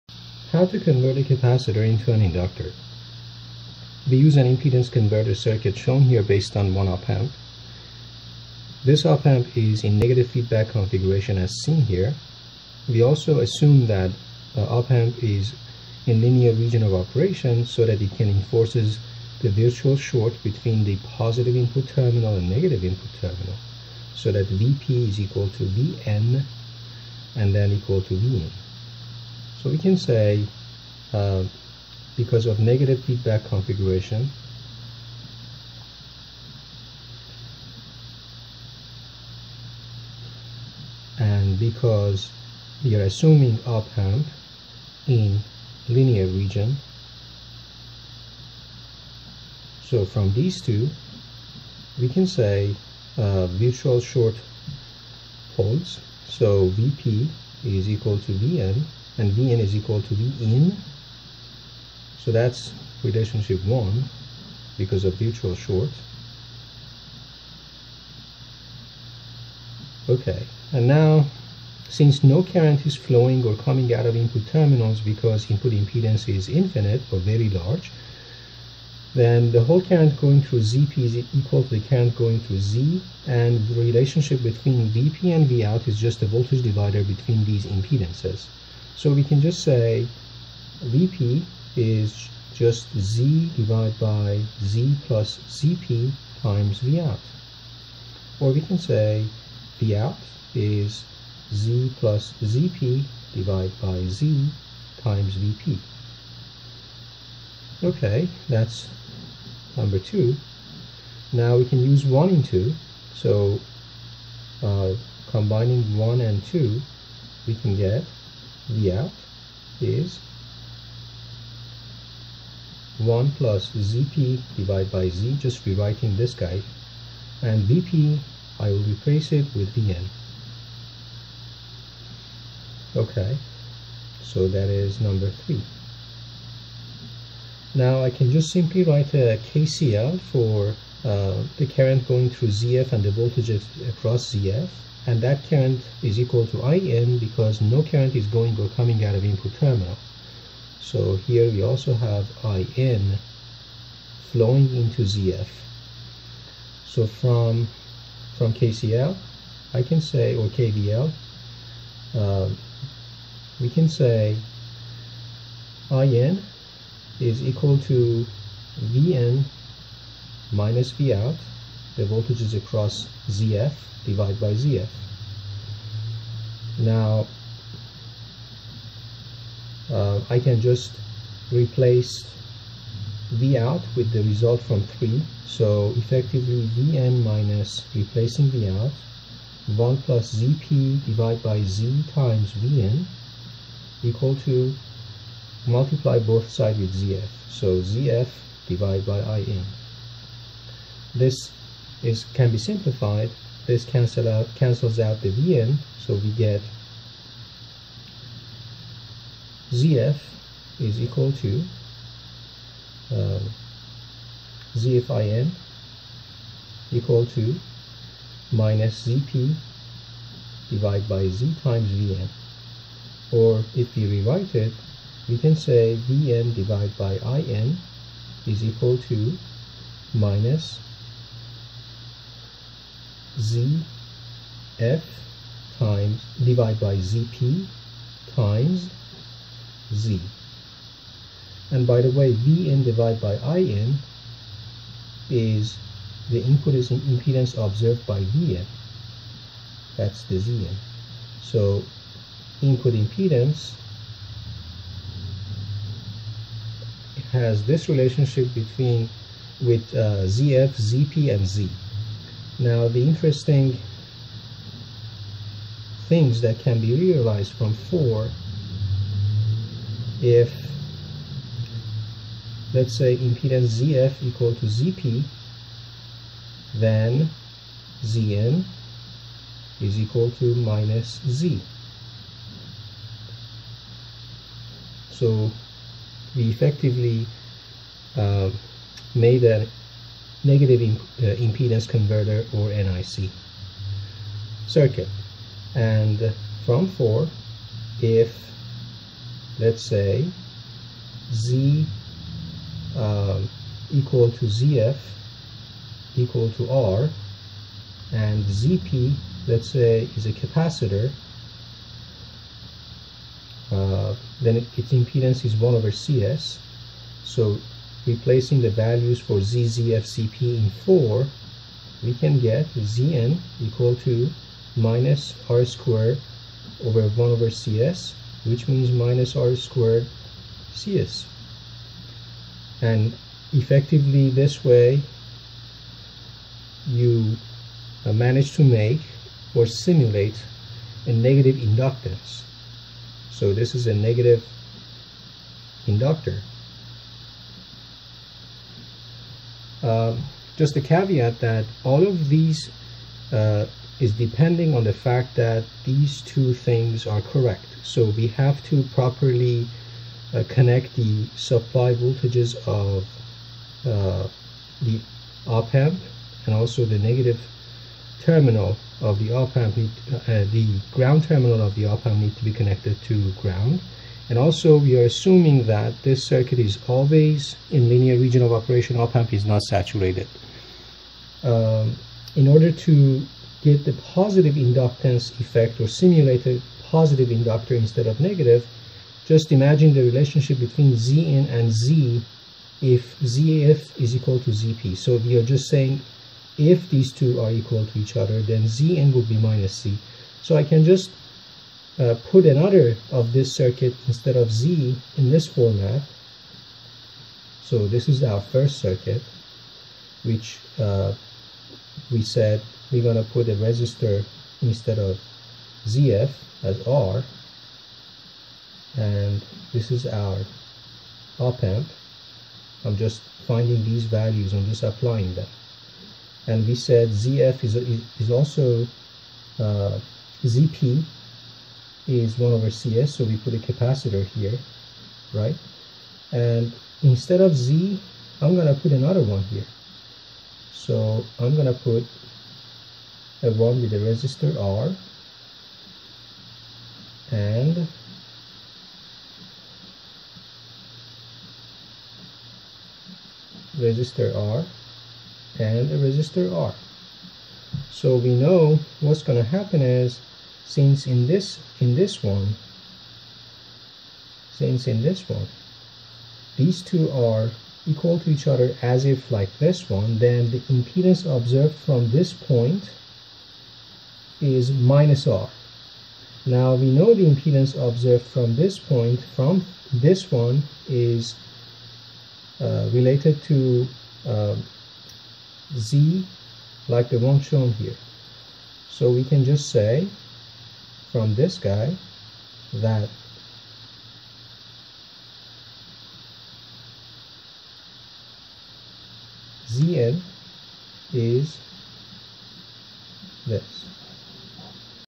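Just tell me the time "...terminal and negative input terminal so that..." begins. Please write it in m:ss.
0:21.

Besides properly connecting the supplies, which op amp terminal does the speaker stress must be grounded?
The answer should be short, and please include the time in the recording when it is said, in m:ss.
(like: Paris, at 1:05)
the ground terminal, at 6:10.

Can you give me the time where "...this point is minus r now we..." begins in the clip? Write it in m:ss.
7:52.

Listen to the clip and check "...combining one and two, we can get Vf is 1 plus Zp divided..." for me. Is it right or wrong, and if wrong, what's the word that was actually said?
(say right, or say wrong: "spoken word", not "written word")
right.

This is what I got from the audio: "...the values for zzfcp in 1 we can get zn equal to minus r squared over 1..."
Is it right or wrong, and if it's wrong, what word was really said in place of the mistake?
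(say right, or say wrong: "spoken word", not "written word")
wrong: "4", not "1".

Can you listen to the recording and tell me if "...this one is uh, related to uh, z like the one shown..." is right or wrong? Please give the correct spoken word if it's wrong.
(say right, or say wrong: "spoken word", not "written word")
right.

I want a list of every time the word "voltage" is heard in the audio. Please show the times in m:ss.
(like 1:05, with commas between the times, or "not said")
1:26, 2:23, 2:52, 6:01.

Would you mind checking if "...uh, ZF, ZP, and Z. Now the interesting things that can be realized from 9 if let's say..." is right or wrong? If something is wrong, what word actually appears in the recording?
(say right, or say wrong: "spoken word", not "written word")
wrong: "4", not "9".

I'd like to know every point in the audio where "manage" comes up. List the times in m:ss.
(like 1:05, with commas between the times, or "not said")
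5:38.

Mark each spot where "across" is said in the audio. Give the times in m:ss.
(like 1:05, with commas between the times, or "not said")
2:23, 2:52.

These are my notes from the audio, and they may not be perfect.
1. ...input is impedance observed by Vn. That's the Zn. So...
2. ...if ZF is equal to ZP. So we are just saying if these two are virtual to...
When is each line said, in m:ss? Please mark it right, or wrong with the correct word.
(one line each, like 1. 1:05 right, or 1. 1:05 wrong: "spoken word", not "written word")
1. 4:06 right
2. 6:32 wrong: "equal", not "virtual".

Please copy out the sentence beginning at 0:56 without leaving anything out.
So VP is equal to VN and Vn is equal to Vin.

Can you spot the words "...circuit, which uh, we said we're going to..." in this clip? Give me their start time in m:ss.
6:48.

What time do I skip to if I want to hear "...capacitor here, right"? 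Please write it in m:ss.
7:13.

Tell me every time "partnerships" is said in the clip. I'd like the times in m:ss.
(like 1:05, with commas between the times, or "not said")
not said.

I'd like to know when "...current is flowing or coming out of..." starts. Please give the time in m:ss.
1:12.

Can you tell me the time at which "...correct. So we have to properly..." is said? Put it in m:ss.
5:57.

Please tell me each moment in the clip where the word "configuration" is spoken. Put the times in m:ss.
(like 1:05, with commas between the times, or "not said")
0:10, 0:33.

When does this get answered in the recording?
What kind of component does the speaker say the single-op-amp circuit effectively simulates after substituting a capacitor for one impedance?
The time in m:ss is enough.
5:43.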